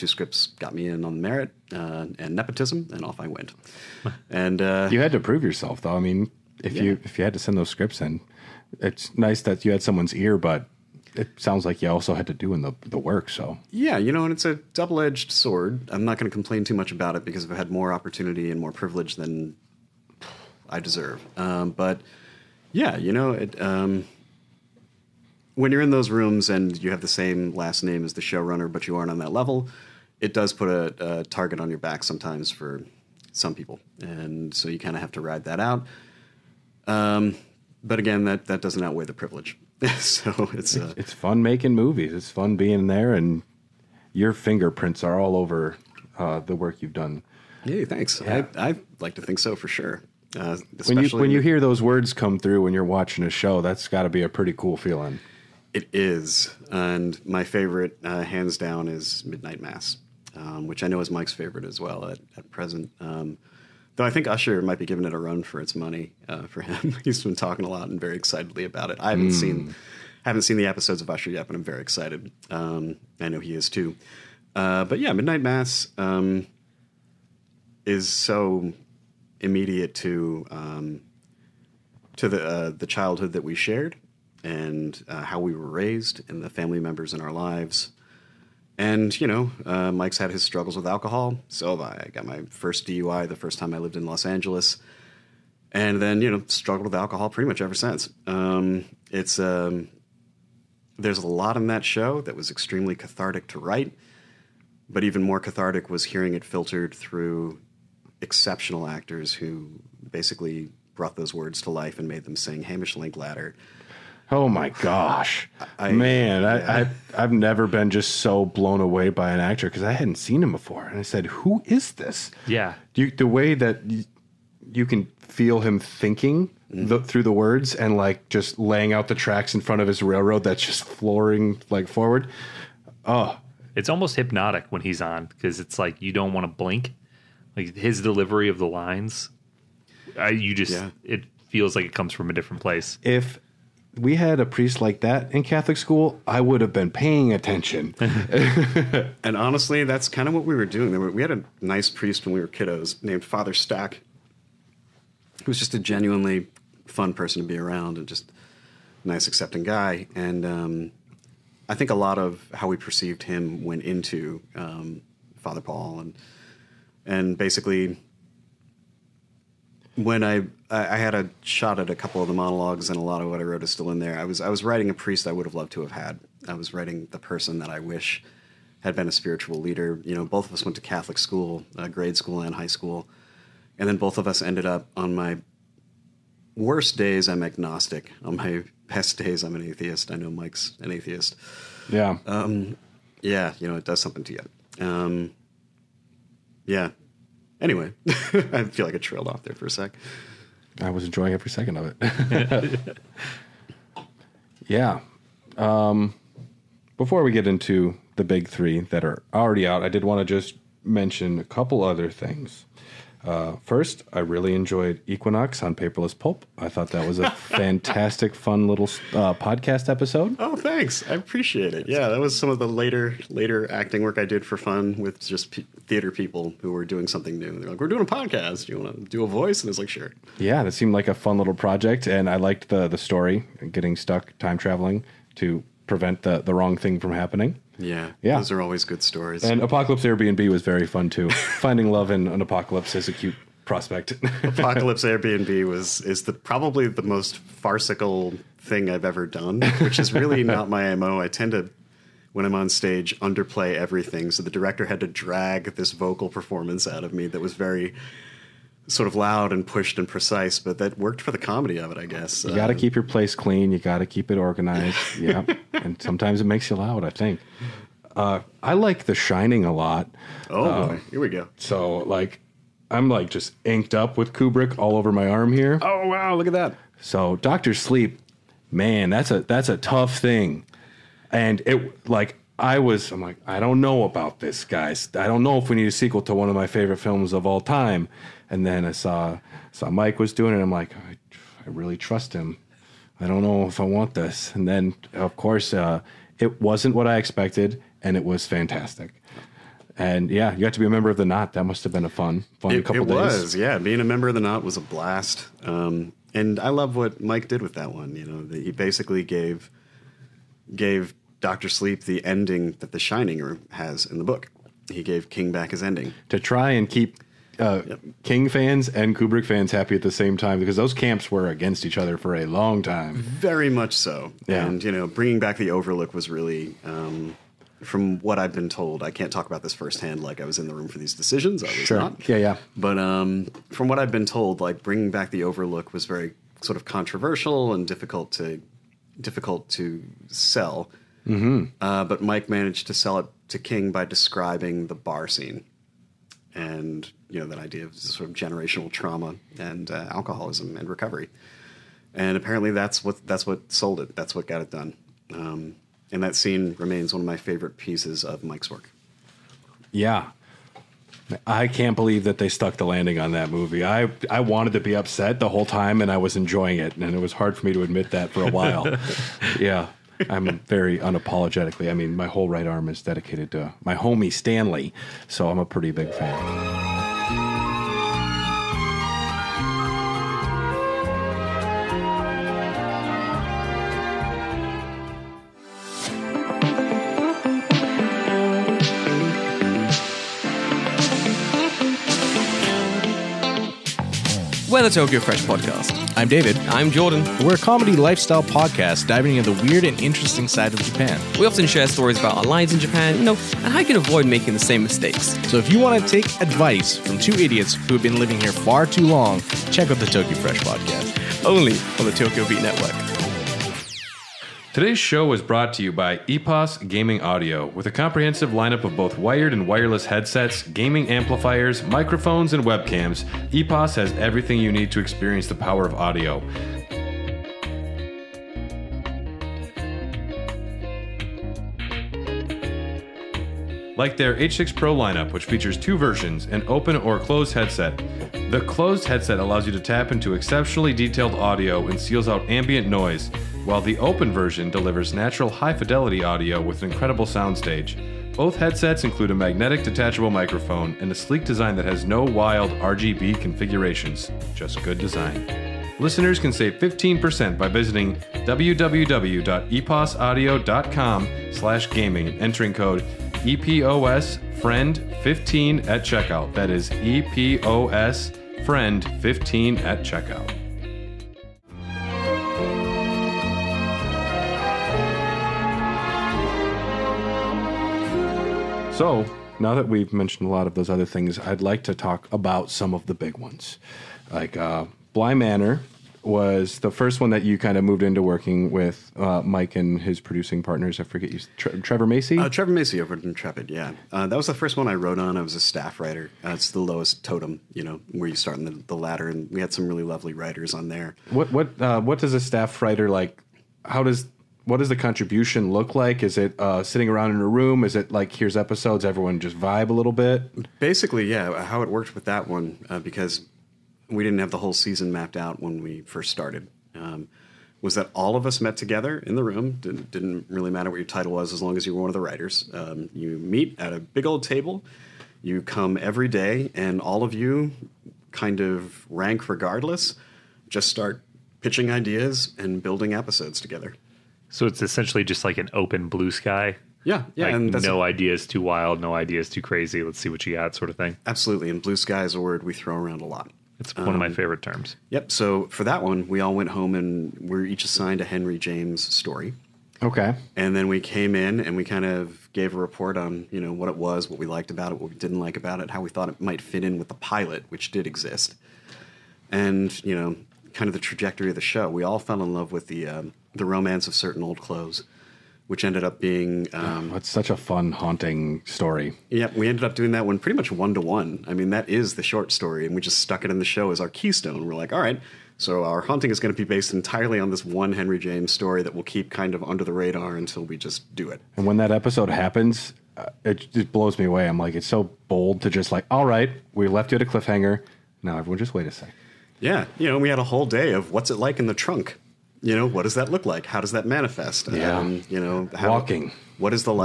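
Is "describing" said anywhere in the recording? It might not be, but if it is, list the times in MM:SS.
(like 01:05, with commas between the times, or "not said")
05:44.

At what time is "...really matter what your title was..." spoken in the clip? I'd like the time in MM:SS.
08:40.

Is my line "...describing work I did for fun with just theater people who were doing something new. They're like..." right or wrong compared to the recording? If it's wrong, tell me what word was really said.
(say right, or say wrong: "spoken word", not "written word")
wrong: "acting", not "describing".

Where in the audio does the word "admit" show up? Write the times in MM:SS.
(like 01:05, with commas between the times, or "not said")
06:07.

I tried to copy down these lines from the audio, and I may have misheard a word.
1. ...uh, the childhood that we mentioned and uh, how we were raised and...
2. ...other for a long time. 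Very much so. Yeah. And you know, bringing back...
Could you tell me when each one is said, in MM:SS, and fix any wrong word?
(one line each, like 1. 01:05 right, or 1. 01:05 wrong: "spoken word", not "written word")
1. 01:22 wrong: "shared", not "mentioned"
2. 05:21 right.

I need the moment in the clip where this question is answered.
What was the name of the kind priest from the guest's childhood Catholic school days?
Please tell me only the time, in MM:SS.
02:33.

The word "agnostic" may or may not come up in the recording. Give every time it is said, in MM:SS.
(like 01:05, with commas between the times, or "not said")
03:07.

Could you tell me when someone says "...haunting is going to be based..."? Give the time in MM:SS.
09:36.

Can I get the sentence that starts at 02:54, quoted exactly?
I was I was writing a priest I would have loved to have had.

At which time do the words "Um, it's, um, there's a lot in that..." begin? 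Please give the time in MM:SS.
01:38.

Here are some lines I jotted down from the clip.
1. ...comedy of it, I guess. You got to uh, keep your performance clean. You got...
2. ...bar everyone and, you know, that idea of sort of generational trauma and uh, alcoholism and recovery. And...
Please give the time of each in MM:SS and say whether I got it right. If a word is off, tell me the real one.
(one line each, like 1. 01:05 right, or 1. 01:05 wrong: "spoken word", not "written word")
1. 04:21 wrong: "place", not "performance"
2. 05:44 wrong: "scene", not "everyone".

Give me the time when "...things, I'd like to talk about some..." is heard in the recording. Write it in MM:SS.
08:01.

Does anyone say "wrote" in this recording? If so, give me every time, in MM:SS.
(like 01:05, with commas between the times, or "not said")
02:53, 08:14.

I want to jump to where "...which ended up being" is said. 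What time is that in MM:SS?
09:25.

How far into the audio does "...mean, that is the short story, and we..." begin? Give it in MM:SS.
09:31.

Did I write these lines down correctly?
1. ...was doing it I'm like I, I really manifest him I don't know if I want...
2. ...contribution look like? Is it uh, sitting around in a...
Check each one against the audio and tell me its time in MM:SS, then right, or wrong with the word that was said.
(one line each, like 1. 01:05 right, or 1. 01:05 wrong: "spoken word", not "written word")
1. 04:50 wrong: "trust", not "manifest"
2. 08:24 right.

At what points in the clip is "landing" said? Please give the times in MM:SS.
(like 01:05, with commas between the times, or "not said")
06:02.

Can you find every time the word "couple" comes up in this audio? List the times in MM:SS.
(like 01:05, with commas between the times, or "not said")
02:51, 03:31, 05:02.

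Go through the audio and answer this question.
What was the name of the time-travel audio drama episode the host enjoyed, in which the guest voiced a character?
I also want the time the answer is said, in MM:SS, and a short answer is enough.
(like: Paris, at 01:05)
Equinox, at 03:35.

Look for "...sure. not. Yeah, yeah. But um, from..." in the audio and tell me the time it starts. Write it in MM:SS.
05:31.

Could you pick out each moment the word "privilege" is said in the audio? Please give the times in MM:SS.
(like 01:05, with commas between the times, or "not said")
00:18, 00:39.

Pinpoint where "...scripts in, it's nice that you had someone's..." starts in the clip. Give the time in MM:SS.
00:07.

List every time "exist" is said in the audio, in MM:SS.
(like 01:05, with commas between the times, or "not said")
09:18.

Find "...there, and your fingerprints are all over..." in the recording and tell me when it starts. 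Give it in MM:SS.
00:42.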